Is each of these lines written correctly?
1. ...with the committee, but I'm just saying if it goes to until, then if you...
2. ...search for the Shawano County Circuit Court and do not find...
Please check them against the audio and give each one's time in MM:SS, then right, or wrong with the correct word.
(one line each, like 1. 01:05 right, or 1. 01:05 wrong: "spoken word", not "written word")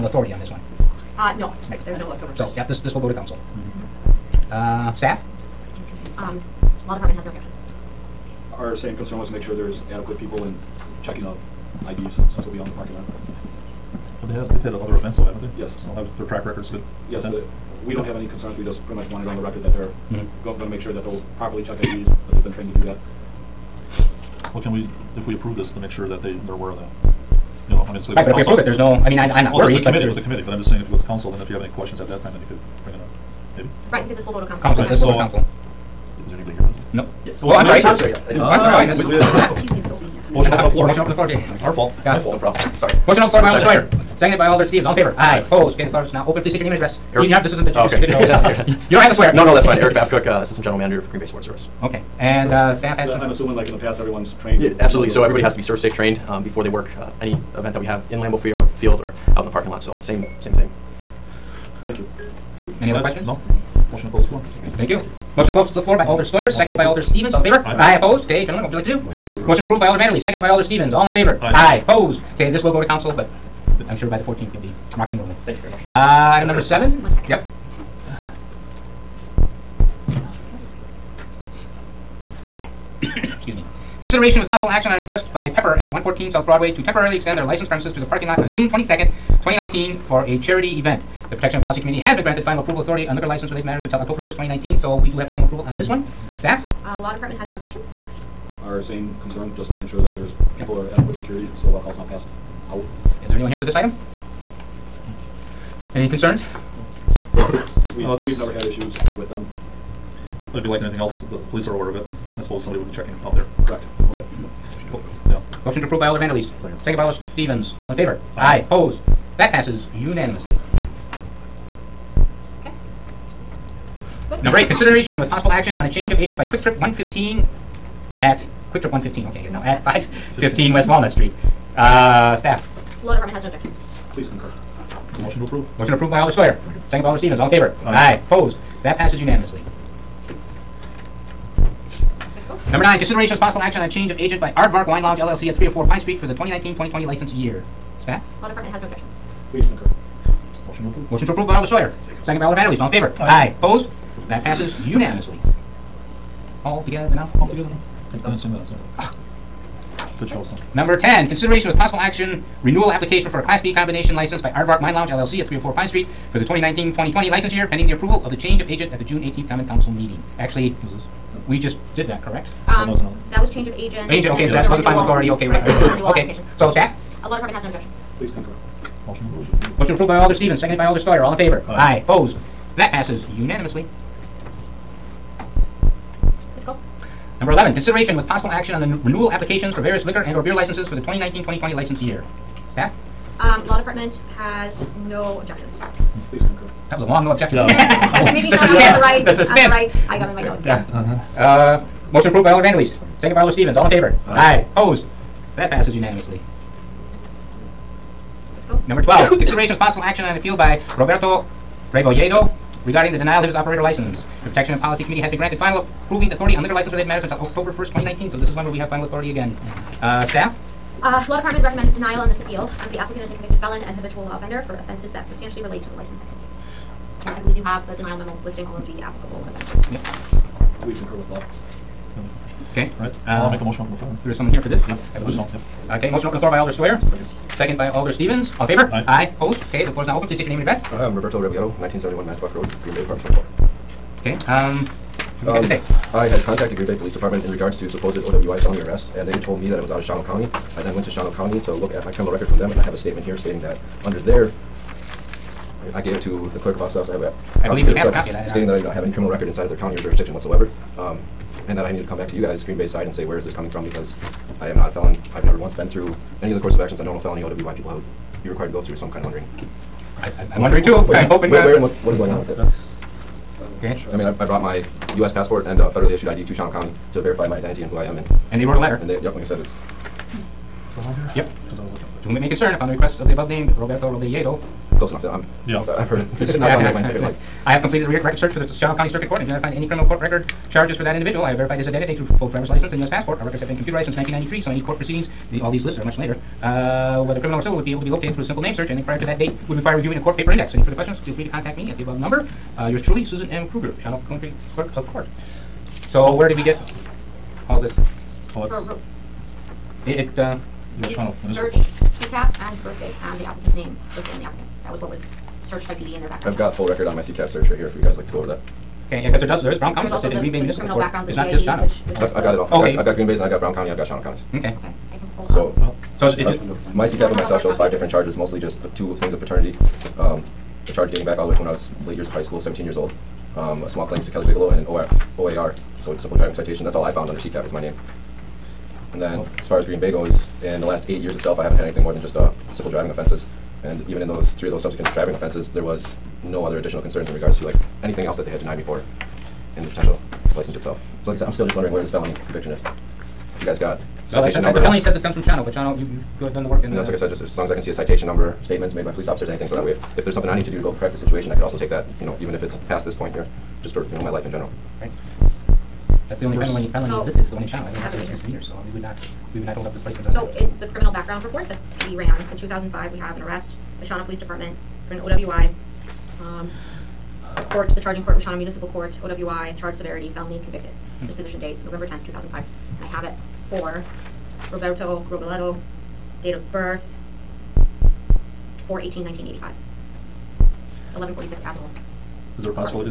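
1. 00:30 wrong: "council", not "until"
2. 04:48 right.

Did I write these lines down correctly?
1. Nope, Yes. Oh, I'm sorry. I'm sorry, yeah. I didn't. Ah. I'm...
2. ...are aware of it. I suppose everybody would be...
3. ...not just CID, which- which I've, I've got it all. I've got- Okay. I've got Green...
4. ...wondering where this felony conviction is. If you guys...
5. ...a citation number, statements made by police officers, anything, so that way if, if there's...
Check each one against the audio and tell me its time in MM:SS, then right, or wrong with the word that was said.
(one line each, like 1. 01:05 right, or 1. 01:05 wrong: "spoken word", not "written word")
1. 00:36 right
2. 01:51 wrong: "somebody", not "everybody"
3. 05:21 right
4. 05:51 right
5. 05:57 right.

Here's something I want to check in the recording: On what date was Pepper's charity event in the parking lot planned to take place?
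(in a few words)
June 22nd, 2019.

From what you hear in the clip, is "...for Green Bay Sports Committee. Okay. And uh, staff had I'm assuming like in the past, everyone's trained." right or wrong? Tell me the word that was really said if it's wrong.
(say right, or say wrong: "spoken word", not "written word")
wrong: "Service", not "Committee".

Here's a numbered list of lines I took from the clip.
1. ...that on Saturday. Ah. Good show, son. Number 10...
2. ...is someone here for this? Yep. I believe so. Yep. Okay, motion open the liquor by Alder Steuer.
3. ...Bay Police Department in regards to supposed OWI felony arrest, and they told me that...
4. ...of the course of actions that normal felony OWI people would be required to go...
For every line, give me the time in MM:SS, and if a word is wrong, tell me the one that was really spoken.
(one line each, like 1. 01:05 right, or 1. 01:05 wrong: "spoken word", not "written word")
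1. 02:38 right
2. 03:54 wrong: "floor", not "liquor"
3. 04:06 right
4. 04:26 right.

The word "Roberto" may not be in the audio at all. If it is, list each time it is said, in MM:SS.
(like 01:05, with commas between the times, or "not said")
03:30, 04:01, 04:43, 06:24.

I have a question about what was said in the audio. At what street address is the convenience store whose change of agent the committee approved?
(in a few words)
515 West Walnut Street.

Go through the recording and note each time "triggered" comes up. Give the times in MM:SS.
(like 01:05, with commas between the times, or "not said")
not said.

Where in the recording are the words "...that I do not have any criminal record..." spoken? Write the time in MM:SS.
04:18.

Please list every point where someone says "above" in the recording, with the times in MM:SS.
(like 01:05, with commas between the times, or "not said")
04:43, 05:02.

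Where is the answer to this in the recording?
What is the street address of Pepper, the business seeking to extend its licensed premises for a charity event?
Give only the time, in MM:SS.
01:25.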